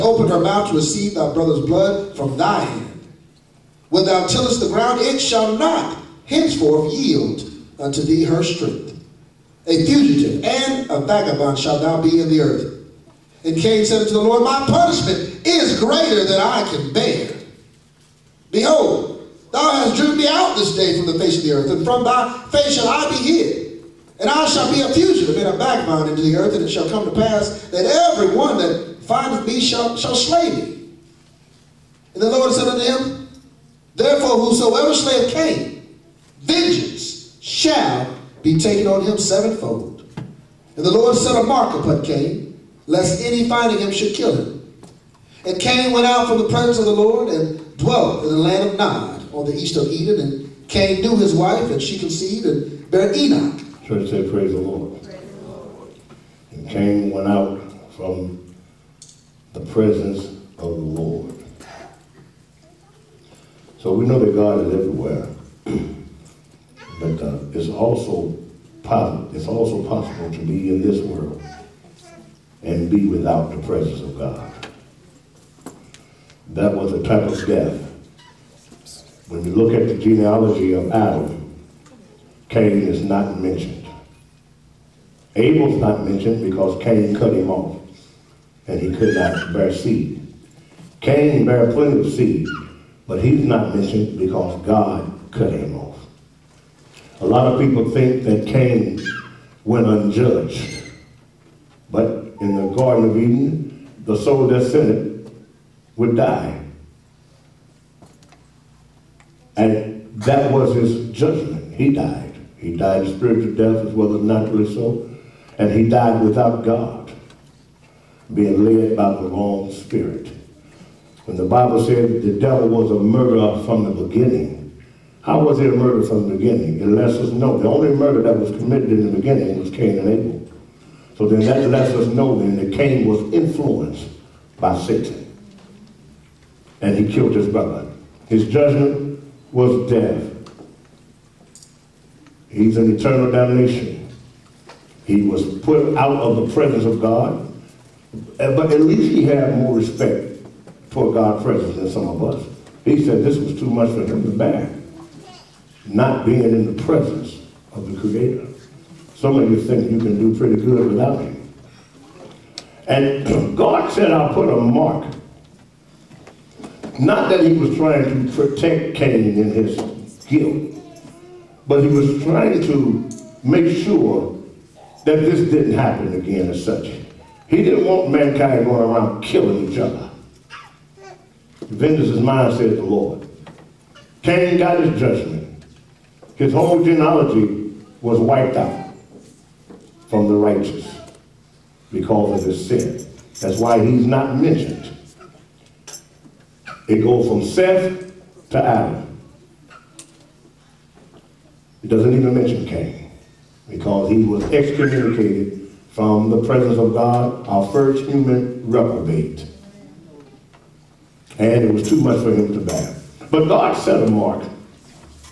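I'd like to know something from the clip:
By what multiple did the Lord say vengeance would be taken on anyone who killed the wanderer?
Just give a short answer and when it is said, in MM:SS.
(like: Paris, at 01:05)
7-fold, at 00:39.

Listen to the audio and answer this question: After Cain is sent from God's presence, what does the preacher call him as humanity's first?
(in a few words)
Human reprobate.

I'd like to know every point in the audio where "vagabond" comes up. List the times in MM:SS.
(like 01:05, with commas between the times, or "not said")
00:10, 00:25.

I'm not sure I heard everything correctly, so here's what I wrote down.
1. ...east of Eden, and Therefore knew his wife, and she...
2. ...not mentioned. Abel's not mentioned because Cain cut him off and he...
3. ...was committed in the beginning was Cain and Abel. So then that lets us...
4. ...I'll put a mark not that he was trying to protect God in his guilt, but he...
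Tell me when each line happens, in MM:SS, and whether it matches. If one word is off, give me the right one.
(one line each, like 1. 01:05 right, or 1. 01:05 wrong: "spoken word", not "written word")
1. 00:49 wrong: "Cain", not "Therefore"
2. 01:23 right
3. 02:08 right
4. 02:44 wrong: "Cain", not "God".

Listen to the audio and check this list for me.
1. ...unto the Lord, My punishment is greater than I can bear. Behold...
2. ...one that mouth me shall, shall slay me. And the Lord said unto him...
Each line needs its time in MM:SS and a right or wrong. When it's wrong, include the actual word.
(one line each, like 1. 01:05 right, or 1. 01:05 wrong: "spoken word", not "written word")
1. 00:14 right
2. 00:28 wrong: "findeth", not "mouth".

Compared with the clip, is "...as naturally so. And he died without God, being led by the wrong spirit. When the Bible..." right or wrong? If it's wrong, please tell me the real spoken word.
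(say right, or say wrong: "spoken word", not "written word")
right.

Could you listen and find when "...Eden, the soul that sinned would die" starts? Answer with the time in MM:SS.
01:43.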